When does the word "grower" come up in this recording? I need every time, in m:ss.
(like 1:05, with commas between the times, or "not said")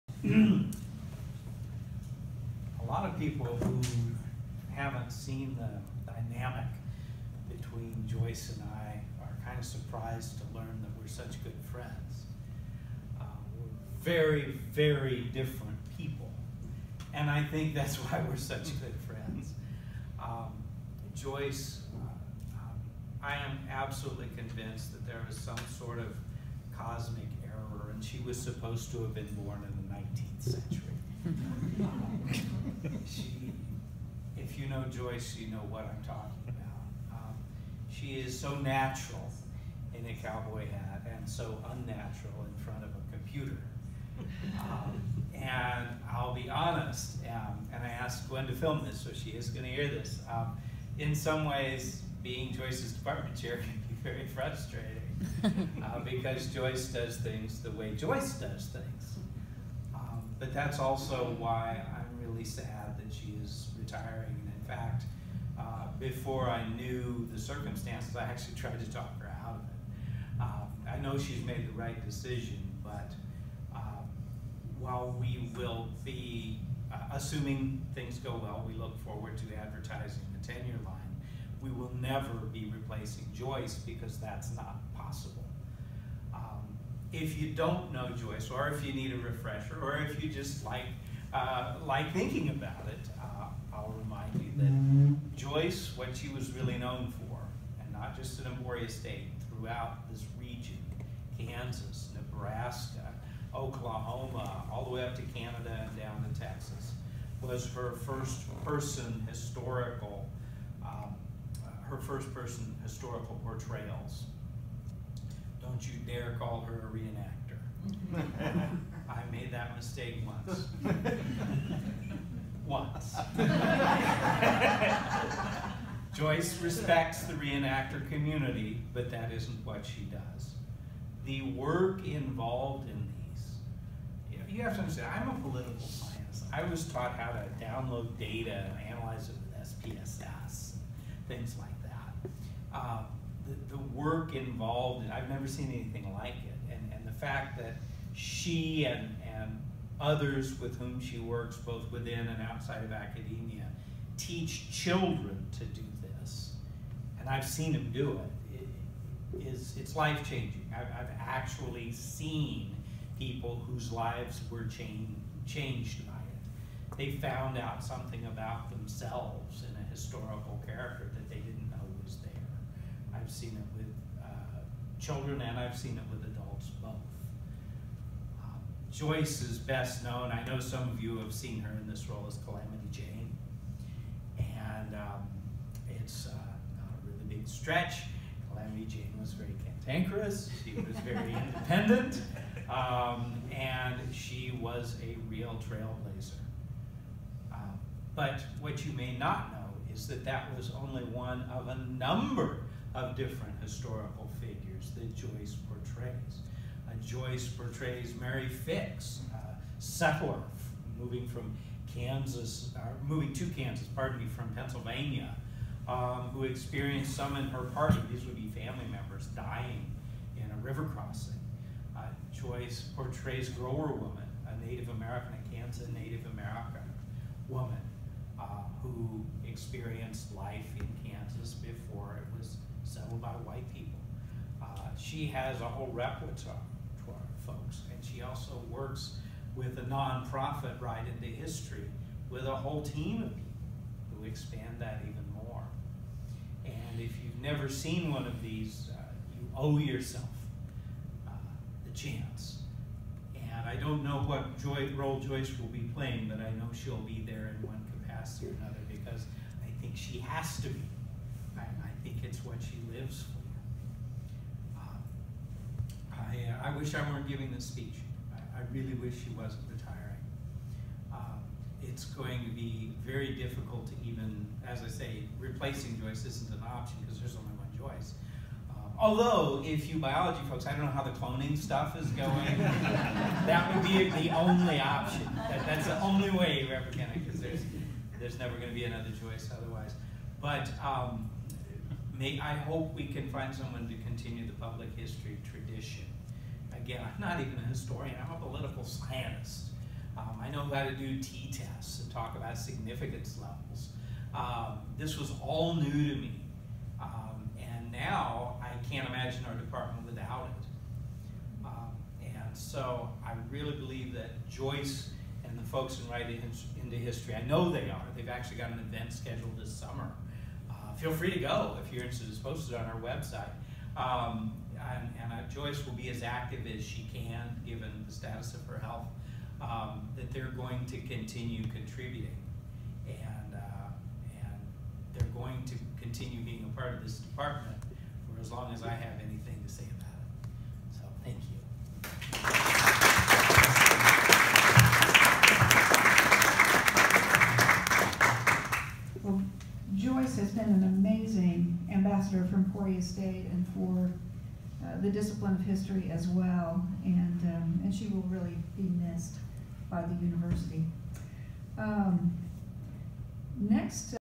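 3:43.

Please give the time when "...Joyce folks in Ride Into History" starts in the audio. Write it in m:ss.
5:14.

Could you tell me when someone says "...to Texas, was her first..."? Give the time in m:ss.
1:46.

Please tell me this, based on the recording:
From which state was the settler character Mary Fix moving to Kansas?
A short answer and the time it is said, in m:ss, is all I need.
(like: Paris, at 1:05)
Pennsylvania, at 3:34.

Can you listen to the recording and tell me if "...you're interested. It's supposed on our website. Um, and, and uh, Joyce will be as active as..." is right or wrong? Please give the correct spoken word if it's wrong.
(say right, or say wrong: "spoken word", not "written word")
wrong: "posted", not "supposed".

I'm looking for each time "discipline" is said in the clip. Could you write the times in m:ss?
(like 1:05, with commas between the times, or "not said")
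5:55.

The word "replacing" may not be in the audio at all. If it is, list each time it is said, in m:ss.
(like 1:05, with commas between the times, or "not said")
1:22, 4:35.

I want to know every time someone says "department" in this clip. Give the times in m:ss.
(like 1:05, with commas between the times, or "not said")
0:52, 5:09, 5:37.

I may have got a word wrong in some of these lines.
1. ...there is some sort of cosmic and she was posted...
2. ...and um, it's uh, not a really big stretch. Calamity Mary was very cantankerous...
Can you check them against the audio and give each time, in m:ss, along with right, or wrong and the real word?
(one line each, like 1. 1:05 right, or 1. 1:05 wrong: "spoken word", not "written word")
1. 0:25 wrong: "supposed", not "posted"
2. 3:04 wrong: "Jane", not "Mary".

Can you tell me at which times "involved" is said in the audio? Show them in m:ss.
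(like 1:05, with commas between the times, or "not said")
2:12, 2:24.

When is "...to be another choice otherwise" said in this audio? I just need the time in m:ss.
4:48.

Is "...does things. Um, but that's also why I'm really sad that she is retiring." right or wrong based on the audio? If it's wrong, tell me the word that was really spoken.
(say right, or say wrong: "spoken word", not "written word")
right.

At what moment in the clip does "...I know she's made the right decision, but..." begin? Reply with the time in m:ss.
1:10.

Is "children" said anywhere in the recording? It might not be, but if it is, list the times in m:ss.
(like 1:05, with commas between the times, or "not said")
2:34, 2:54.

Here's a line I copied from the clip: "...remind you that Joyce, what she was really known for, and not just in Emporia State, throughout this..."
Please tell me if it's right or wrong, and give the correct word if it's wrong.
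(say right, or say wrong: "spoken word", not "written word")
right.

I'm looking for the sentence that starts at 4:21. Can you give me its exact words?
I, I think it's what she lives for.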